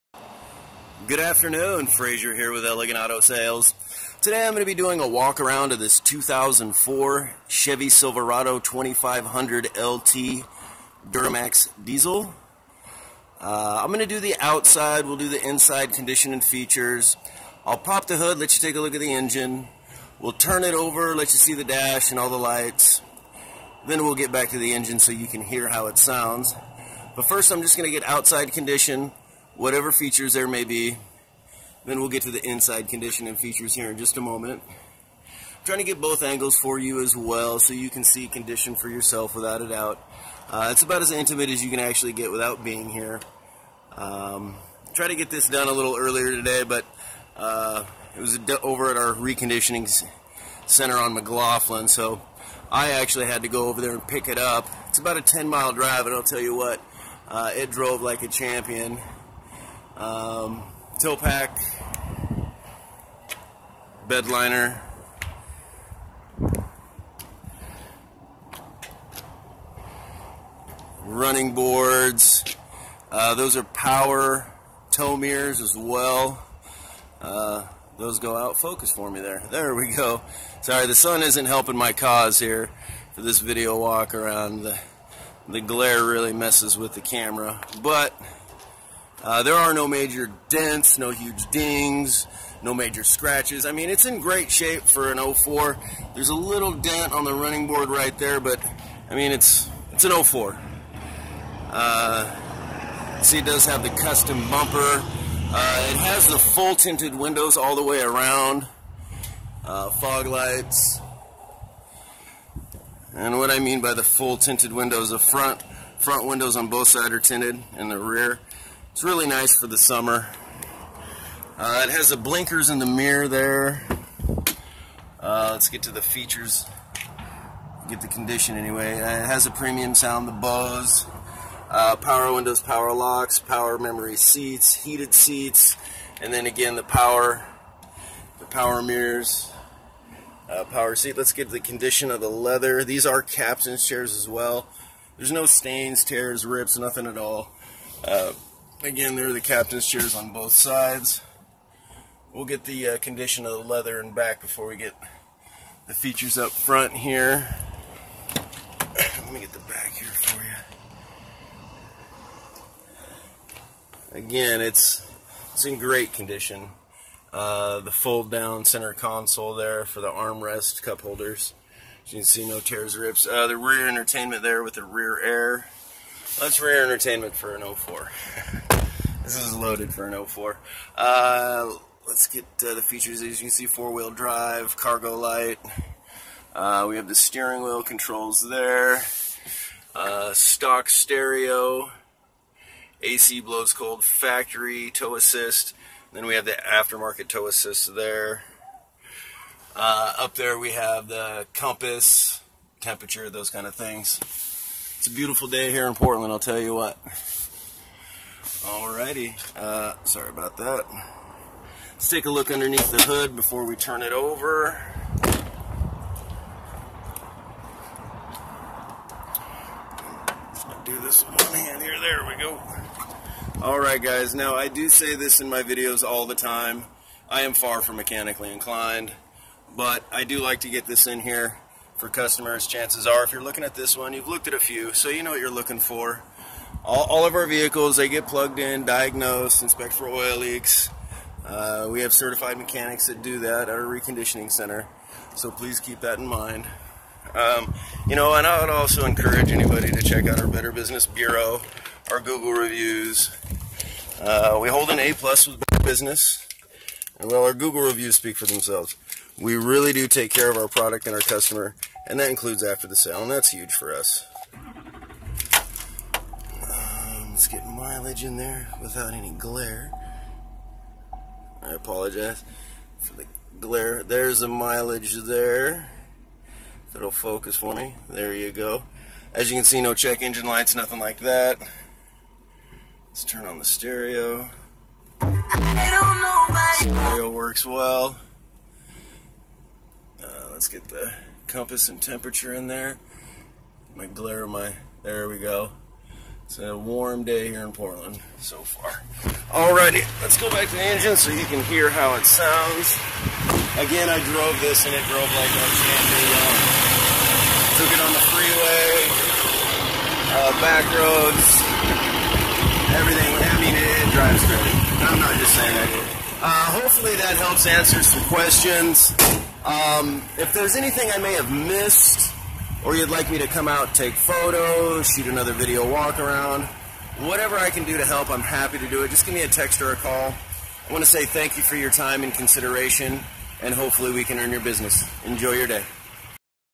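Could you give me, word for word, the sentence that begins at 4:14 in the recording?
Uh, we hold an A plus with Better Business, and well, our Google reviews speak for themselves.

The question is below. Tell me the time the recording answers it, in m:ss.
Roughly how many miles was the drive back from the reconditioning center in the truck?
0:55.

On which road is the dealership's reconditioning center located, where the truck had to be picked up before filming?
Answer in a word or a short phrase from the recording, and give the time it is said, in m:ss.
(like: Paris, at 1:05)
McLoughlin, at 0:51.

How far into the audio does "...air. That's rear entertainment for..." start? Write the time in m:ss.
2:55.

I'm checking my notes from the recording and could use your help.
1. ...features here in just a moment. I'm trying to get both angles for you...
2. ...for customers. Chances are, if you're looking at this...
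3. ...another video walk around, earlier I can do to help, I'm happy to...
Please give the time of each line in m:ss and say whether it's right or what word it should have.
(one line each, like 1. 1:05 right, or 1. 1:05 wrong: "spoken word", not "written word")
1. 0:33 right
2. 3:51 right
3. 5:25 wrong: "whatever", not "earlier".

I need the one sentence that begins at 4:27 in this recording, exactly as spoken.
Let's get mileage in there without any glare.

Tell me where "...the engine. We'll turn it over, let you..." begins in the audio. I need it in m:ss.
0:19.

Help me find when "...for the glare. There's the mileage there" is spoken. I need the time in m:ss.
4:32.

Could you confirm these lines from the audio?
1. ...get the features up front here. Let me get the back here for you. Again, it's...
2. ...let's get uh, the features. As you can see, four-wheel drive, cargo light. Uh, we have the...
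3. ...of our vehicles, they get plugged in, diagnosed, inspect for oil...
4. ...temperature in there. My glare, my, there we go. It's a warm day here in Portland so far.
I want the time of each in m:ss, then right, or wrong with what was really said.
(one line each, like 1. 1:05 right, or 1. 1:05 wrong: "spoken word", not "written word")
1. 2:34 right
2. 3:02 right
3. 3:57 right
4. 4:51 right.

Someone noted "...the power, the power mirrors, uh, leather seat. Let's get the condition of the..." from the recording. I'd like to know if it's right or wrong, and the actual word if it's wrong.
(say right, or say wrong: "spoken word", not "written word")
wrong: "power", not "leather".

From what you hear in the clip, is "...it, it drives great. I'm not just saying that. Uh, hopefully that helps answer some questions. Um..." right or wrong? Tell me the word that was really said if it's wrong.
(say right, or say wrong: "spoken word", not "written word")
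right.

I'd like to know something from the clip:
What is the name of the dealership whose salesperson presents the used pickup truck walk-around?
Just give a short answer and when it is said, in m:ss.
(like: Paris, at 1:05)
Elegant Auto Sales, at 0:02.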